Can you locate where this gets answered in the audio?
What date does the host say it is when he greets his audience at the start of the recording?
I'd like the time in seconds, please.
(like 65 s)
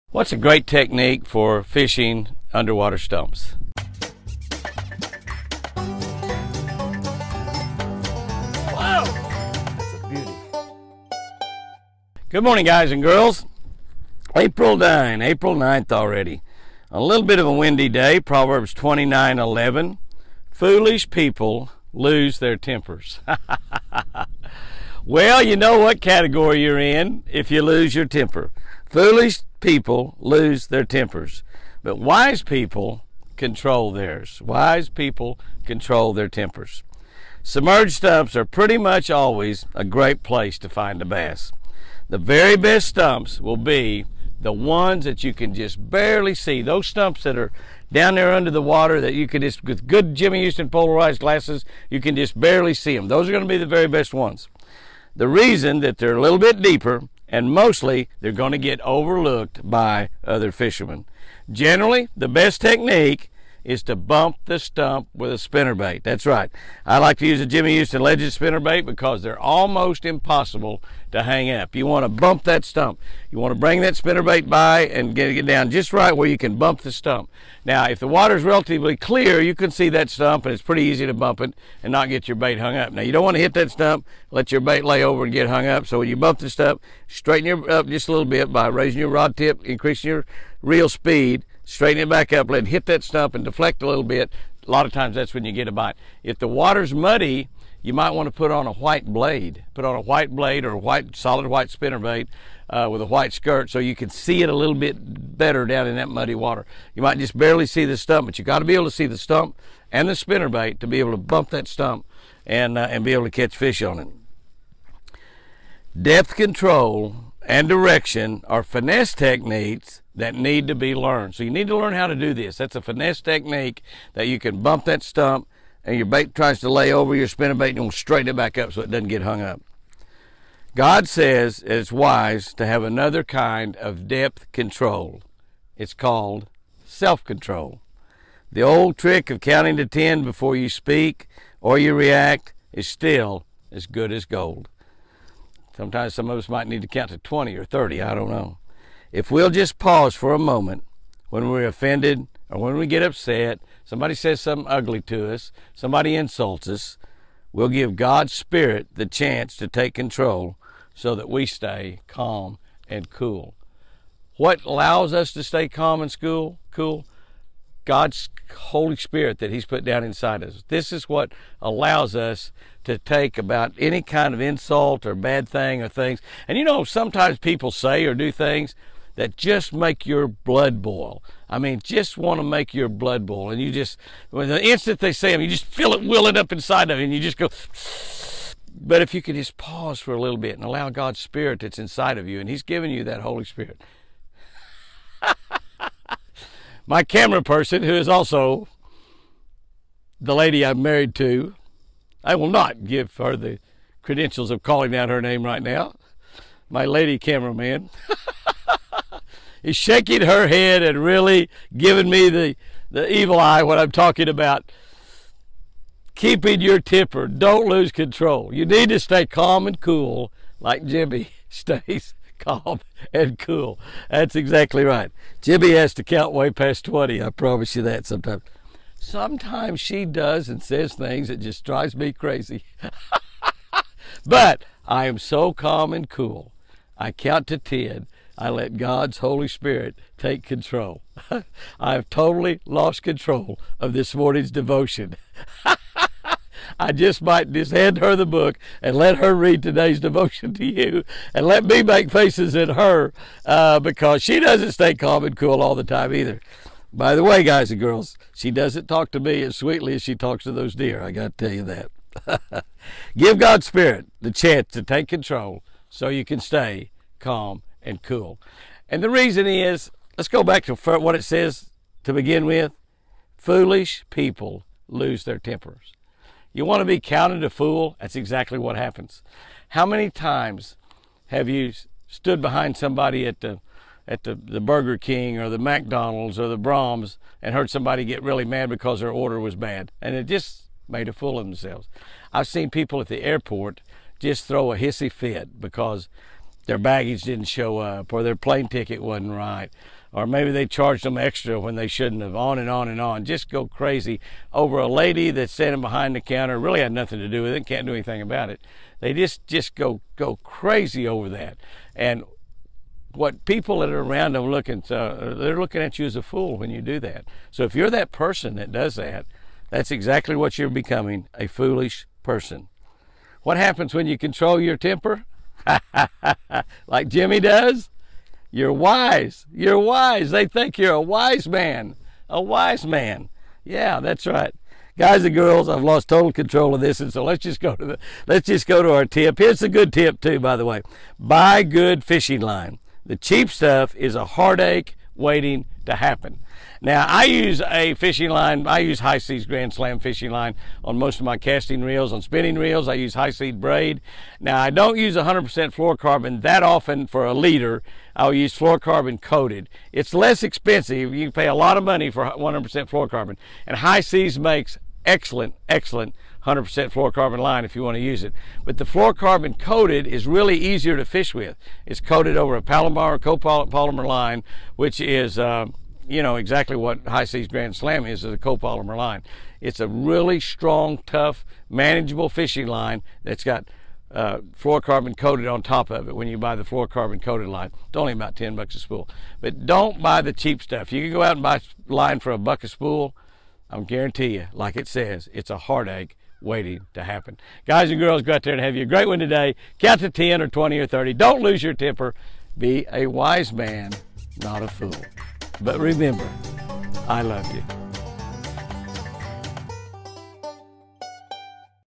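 15 s.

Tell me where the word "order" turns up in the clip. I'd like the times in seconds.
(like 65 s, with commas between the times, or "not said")
289 s.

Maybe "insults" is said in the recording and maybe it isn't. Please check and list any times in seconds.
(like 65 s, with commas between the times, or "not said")
156 s, 174 s.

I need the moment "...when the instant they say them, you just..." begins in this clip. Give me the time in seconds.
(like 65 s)
184 s.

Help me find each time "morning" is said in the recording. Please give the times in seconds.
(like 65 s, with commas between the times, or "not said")
12 s, 244 s.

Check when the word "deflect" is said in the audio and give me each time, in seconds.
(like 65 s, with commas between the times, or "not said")
93 s.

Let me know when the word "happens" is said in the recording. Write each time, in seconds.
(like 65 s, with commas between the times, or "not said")
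278 s, 323 s, 345 s, 397 s.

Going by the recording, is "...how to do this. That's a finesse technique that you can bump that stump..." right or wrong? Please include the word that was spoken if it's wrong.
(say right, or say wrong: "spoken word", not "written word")
right.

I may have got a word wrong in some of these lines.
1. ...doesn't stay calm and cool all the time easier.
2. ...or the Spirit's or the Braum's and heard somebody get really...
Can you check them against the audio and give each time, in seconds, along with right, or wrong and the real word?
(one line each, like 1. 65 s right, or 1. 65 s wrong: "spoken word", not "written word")
1. 254 s wrong: "either", not "easier"
2. 285 s wrong: "McDonald", not "Spirit".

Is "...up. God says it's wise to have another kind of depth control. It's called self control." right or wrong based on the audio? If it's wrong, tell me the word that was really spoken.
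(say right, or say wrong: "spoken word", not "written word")
right.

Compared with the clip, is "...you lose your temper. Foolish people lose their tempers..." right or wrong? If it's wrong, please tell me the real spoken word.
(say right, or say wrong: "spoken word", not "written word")
right.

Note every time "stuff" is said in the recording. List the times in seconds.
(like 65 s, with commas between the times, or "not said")
343 s, 390 s.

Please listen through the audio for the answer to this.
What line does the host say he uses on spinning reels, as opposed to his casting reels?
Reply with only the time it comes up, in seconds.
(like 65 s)
353 s.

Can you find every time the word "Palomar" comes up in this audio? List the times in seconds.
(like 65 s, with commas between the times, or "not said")
372 s.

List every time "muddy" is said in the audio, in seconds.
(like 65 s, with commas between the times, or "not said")
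96 s, 106 s.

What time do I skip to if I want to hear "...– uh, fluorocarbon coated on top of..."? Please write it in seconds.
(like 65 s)
383 s.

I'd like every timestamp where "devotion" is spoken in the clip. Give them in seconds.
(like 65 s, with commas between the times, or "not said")
244 s, 249 s.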